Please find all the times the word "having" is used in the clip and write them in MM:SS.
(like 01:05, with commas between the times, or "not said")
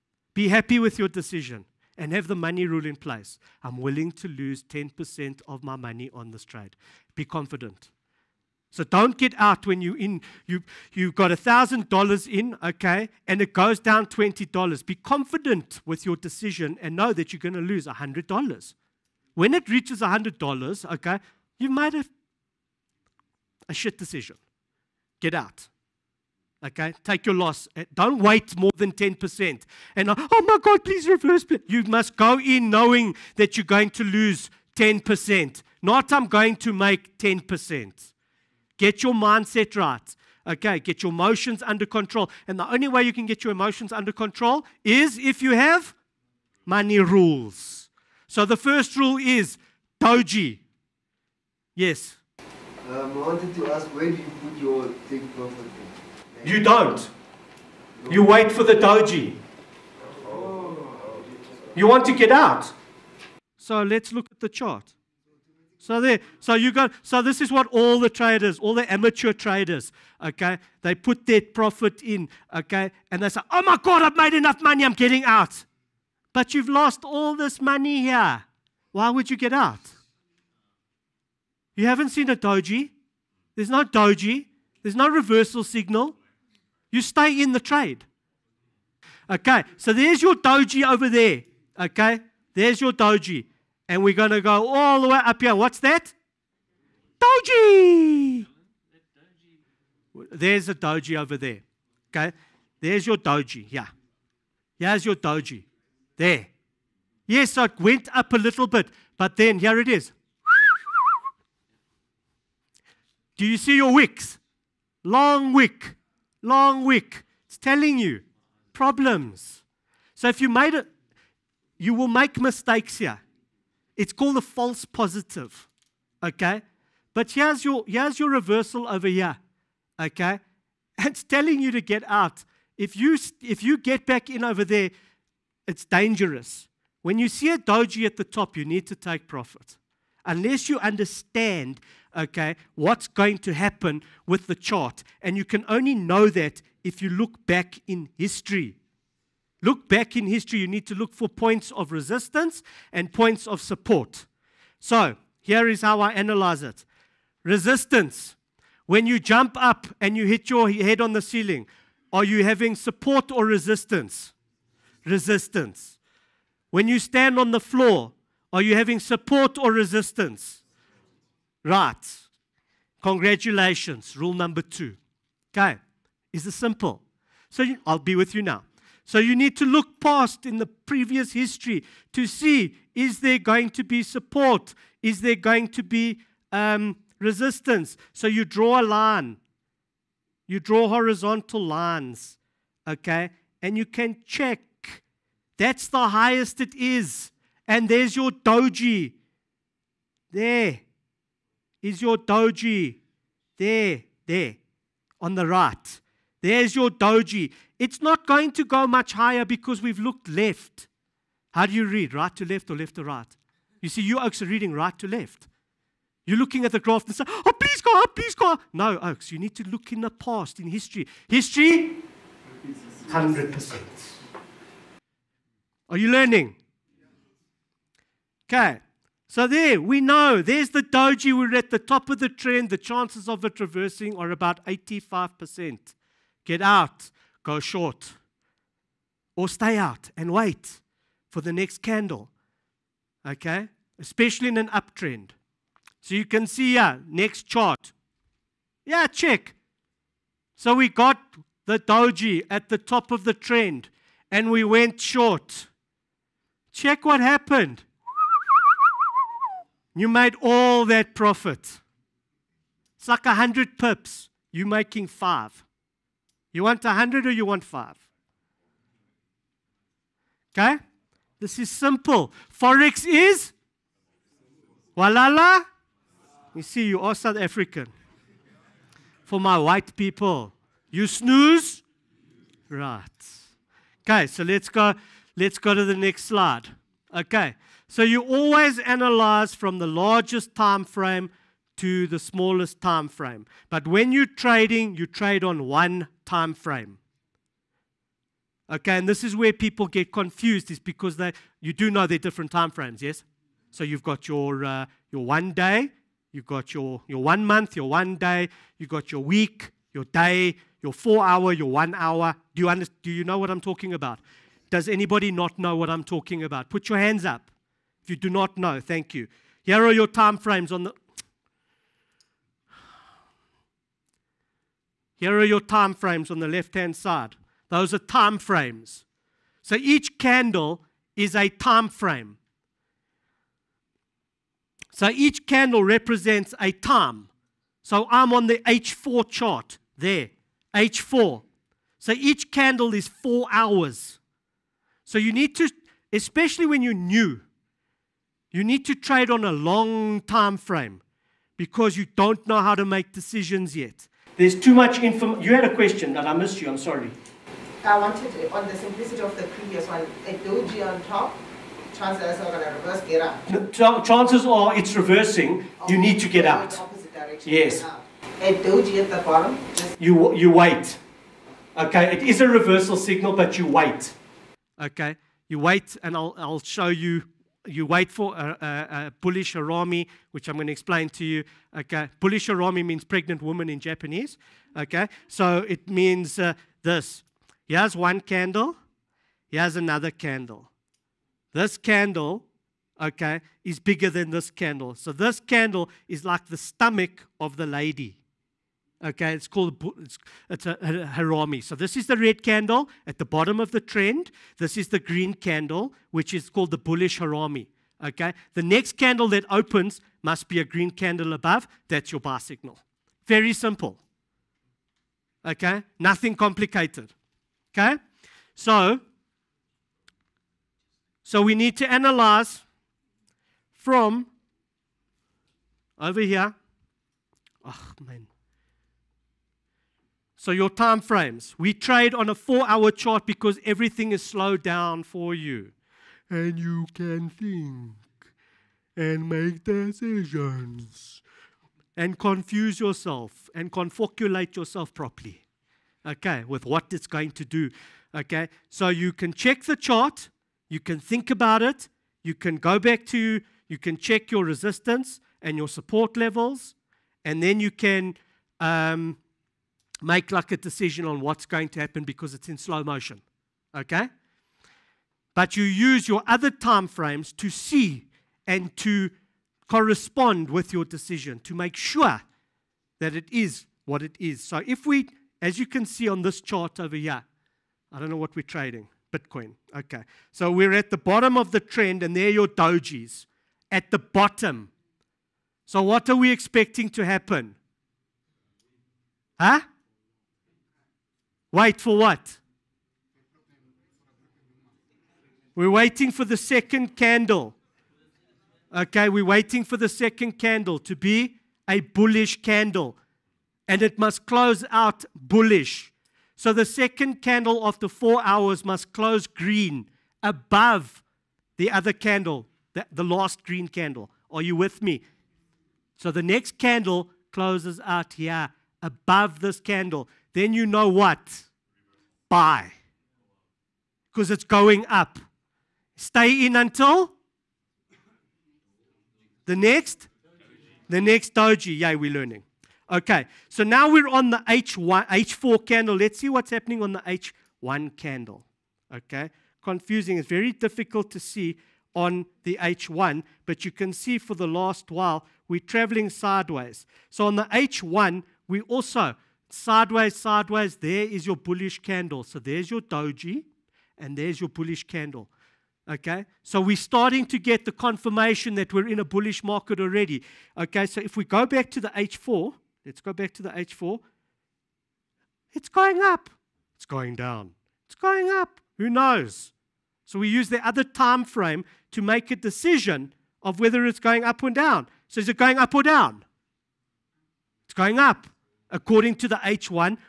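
02:42, 02:48.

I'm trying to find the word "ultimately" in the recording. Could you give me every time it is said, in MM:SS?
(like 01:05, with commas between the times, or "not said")
not said.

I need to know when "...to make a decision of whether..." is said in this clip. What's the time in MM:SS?
09:31.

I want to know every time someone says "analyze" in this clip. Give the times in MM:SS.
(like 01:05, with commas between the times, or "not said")
02:36, 04:48, 07:01.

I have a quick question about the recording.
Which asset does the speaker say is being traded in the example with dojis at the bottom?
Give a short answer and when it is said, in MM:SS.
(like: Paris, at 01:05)
Bitcoin, at 07:59.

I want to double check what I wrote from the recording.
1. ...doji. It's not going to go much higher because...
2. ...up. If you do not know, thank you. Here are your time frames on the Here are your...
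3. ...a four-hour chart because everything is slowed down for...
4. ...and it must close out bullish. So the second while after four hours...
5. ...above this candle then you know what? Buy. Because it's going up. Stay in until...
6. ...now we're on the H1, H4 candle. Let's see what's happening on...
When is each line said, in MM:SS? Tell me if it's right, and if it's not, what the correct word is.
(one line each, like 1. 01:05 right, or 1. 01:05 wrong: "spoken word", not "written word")
1. 03:26 right
2. 05:17 right
3. 07:12 right
4. 08:23 wrong: "candle", not "while"
5. 08:38 right
6. 08:53 right.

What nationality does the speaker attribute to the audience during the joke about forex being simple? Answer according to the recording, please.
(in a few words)
South African.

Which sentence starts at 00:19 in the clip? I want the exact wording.
When it reaches hundred dollars, okay, you might have a shit decision.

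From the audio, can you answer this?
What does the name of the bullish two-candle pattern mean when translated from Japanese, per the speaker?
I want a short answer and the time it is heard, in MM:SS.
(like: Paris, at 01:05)
Pregnant woman, at 06:23.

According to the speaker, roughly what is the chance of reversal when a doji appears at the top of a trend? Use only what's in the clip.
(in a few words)
85%.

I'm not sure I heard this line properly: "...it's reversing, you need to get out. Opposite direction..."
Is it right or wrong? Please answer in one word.
right.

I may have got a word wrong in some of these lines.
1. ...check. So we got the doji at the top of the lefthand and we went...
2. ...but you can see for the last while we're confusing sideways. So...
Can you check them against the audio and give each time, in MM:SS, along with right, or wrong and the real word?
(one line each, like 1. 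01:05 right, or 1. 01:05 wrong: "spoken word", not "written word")
1. 04:09 wrong: "trend", not "lefthand"
2. 09:03 wrong: "traveling", not "confusing".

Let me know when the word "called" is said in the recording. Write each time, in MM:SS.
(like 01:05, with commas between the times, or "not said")
02:04, 06:39, 06:46.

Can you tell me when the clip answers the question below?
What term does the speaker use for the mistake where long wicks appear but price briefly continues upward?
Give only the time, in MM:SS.
02:04.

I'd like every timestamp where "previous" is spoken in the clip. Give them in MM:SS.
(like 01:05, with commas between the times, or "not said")
03:00, 05:59.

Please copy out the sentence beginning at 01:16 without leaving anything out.
But you've lost all this money here.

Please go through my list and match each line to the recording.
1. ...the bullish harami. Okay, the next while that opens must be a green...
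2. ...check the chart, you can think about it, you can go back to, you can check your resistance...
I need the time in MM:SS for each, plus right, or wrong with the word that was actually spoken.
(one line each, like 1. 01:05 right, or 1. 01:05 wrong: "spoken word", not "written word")
1. 06:46 wrong: "candle", not "while"
2. 07:29 right.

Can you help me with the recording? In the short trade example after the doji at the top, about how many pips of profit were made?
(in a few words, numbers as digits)
100 pips.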